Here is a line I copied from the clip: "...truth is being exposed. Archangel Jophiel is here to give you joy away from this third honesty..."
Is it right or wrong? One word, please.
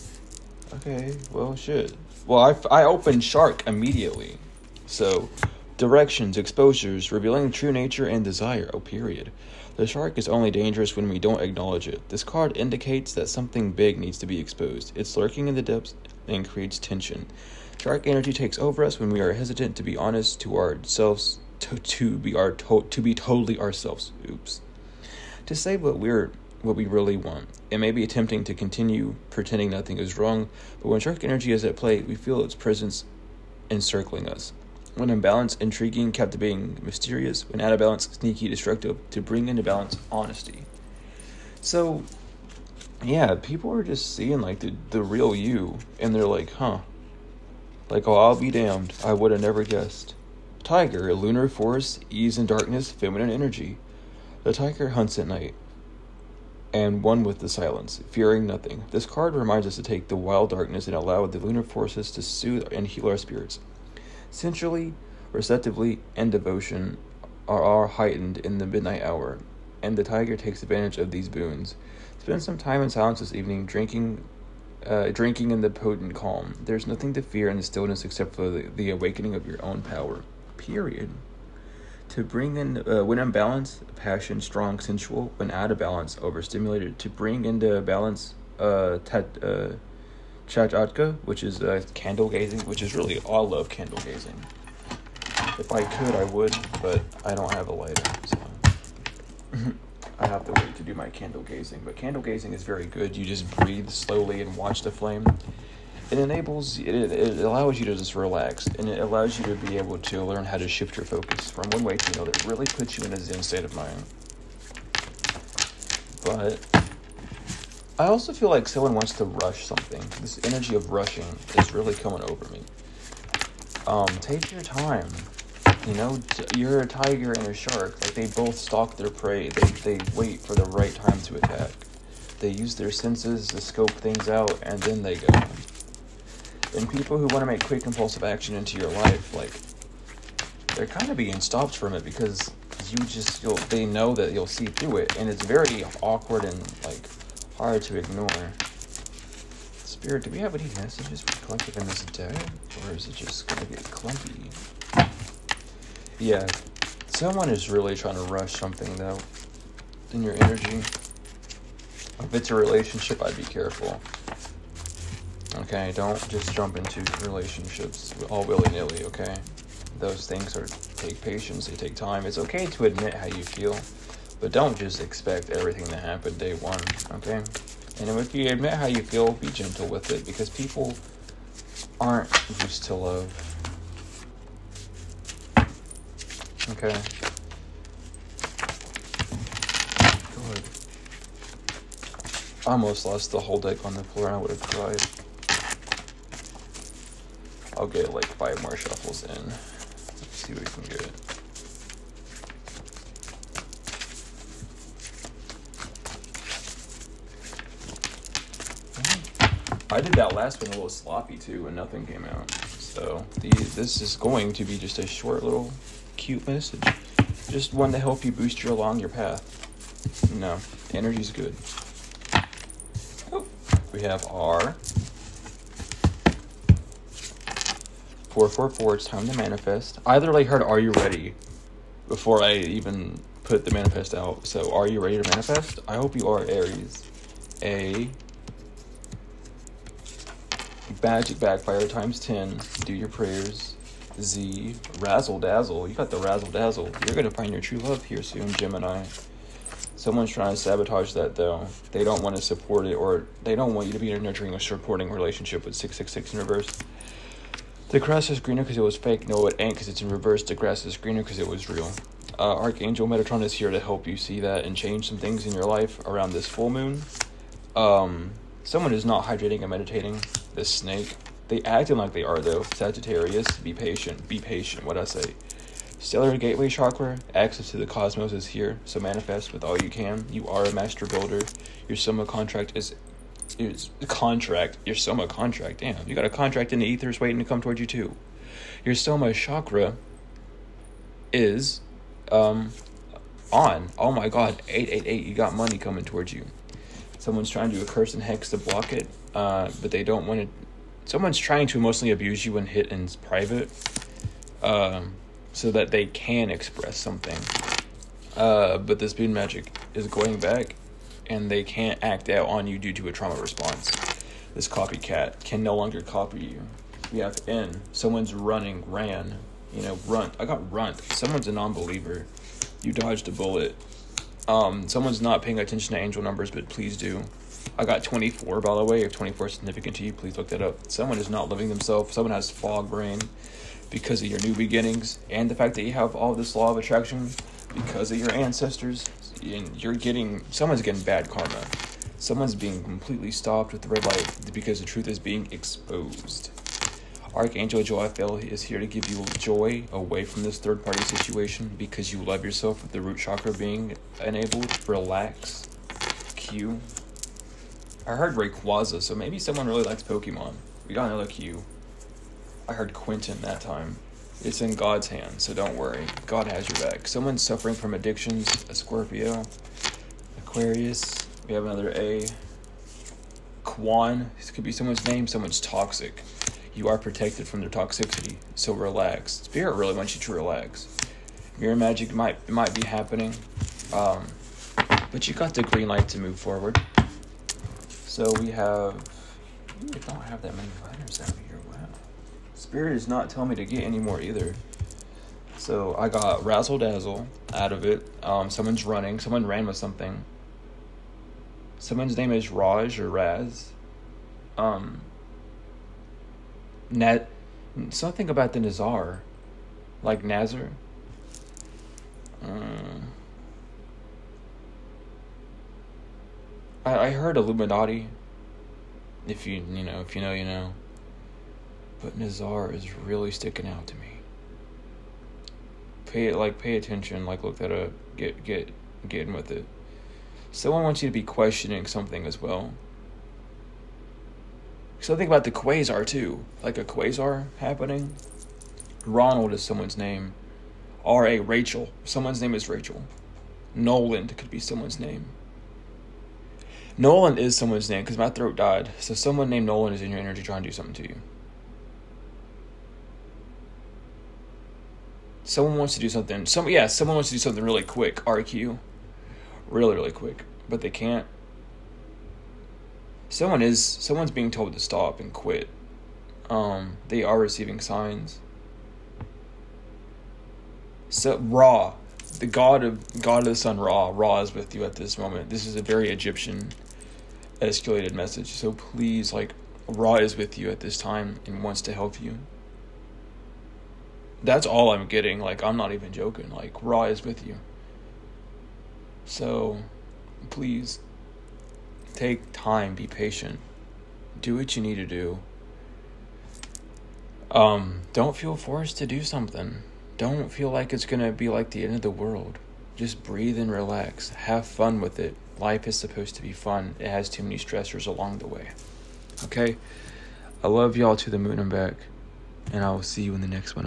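wrong.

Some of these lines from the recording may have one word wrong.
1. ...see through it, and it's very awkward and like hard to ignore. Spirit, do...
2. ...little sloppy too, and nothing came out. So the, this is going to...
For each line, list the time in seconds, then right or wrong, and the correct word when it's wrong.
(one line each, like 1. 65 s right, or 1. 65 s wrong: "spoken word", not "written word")
1. 144 s right
2. 210 s right.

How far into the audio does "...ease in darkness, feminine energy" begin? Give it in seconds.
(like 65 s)
52 s.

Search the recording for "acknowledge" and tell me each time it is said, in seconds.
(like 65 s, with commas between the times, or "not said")
11 s.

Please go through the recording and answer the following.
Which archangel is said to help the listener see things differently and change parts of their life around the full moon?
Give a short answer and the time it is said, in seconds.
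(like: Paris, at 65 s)
Metatron, at 263 s.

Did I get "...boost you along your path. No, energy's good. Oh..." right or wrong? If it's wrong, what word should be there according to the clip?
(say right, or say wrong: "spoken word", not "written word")
right.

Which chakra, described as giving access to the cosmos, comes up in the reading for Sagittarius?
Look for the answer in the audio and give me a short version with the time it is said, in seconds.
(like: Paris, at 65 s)
Stellar Gateway Chakra, at 275 s.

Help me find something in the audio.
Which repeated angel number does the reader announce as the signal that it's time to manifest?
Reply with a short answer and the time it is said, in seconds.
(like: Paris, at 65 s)
444, at 228 s.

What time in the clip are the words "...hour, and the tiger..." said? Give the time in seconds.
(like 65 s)
69 s.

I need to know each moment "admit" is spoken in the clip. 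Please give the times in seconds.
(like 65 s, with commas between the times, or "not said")
172 s, 178 s.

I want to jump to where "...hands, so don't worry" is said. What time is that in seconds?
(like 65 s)
365 s.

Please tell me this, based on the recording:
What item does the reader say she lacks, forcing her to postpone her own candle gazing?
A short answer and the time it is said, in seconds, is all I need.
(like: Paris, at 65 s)
A lighter, at 97 s.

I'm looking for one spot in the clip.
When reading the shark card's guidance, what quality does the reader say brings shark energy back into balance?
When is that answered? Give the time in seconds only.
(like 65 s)
40 s.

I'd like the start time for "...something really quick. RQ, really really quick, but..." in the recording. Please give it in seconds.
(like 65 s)
457 s.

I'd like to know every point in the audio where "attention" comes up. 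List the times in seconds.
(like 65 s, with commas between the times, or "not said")
325 s, 426 s.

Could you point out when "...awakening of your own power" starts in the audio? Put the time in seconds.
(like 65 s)
78 s.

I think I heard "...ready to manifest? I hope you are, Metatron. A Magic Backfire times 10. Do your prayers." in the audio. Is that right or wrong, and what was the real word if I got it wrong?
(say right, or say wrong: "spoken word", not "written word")
wrong: "Aries", not "Metatron".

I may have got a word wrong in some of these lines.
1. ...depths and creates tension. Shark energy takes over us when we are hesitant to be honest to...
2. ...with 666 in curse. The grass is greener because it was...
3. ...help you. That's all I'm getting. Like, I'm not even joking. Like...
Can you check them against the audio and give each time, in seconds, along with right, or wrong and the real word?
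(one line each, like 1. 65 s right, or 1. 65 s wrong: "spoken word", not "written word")
1. 15 s right
2. 255 s wrong: "reverse", not "curse"
3. 481 s right.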